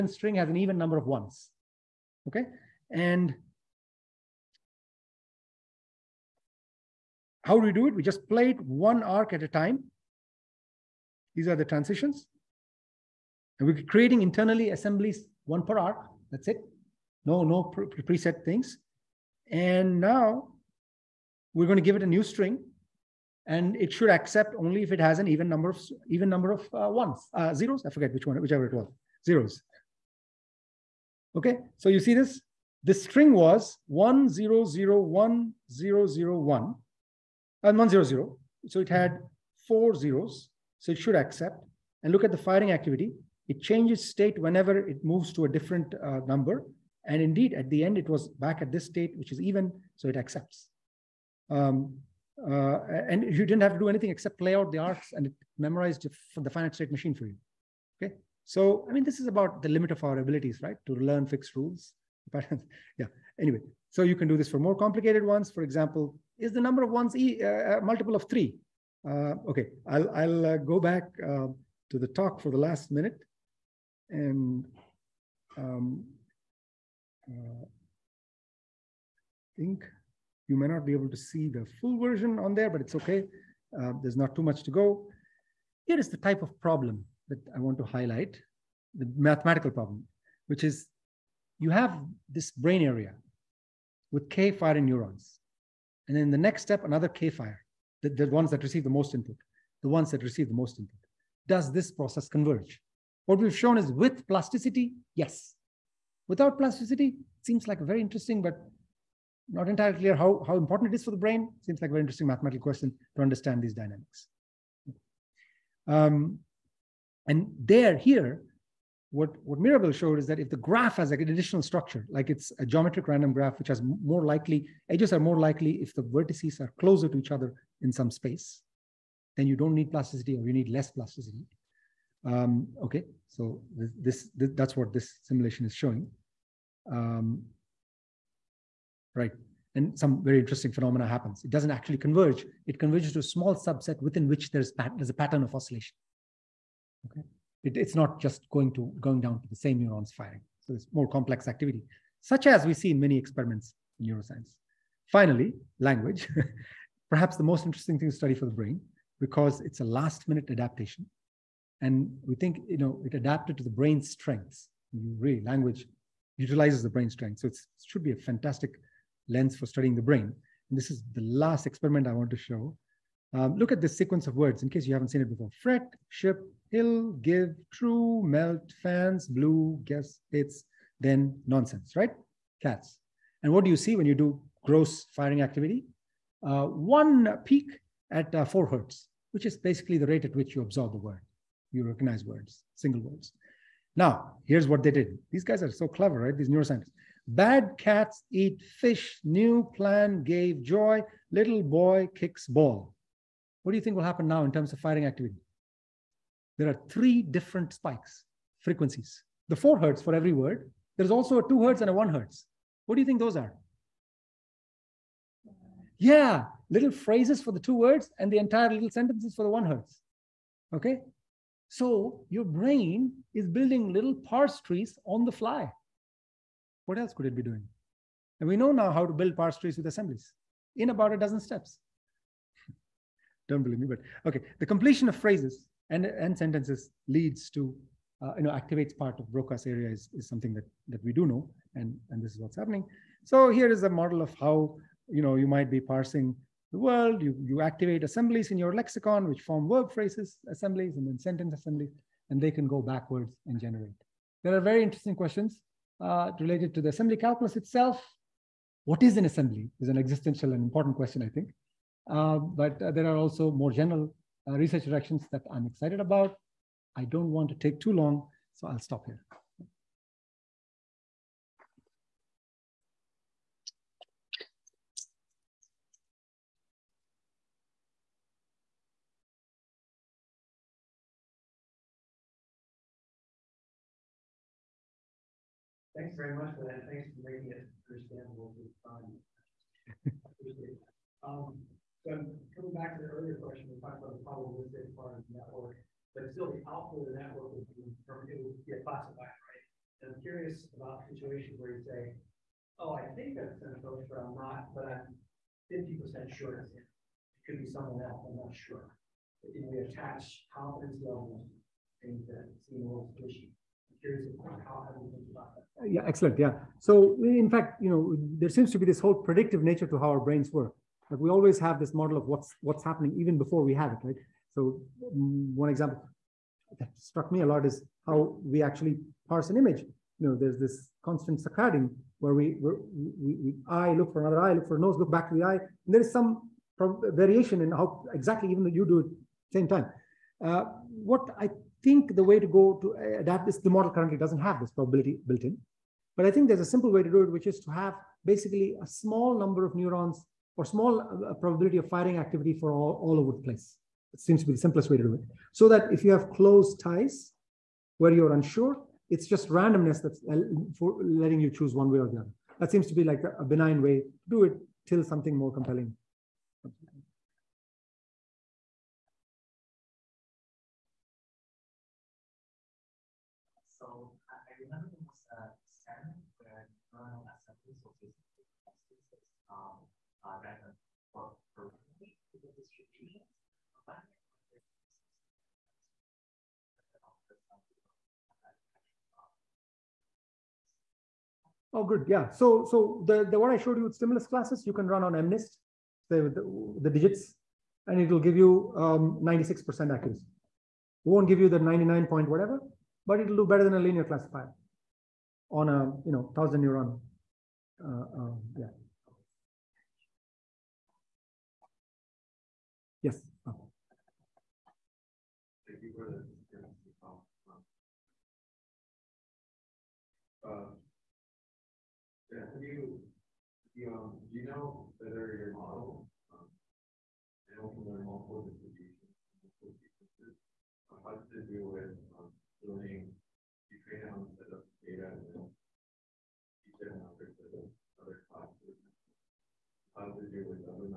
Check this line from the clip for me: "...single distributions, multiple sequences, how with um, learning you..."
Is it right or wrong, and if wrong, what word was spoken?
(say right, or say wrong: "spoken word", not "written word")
wrong: "multiple", not "single".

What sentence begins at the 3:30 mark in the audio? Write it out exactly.
There's also a two hertz and a one hertz.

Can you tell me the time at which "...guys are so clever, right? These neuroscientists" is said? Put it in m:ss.
3:15.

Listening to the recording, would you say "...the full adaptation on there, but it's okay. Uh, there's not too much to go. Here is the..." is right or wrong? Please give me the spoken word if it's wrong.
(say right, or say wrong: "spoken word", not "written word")
wrong: "version", not "adaptation".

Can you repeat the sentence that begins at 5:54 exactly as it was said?
It seems to be the simplest way to do it.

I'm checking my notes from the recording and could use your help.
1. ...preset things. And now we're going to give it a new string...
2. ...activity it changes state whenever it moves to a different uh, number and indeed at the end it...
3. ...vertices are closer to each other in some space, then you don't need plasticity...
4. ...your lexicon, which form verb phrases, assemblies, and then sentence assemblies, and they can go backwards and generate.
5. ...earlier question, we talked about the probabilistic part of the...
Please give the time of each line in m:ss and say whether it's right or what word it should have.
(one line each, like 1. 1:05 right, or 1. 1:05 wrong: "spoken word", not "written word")
1. 0:17 right
2. 0:42 right
3. 2:06 right
4. 4:08 right
5. 4:53 right.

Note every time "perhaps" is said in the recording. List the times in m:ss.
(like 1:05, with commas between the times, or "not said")
2:37.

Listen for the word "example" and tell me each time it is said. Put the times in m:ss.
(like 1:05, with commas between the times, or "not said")
1:05, 5:25.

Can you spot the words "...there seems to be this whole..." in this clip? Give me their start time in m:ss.
5:18.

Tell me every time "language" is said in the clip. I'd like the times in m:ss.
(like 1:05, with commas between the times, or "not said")
2:35, 2:45.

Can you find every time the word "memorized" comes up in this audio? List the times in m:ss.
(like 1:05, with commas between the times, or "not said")
0:55.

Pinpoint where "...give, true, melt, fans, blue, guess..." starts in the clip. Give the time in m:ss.
2:57.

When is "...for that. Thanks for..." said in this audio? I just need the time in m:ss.
4:46.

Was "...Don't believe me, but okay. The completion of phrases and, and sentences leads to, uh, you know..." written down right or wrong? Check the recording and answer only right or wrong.
right.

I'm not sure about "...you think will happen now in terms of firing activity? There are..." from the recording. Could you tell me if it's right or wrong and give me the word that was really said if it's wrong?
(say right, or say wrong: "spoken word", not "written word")
right.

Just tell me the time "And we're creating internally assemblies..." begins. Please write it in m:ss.
0:13.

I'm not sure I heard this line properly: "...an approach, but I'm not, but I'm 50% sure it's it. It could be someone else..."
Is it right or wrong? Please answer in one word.
right.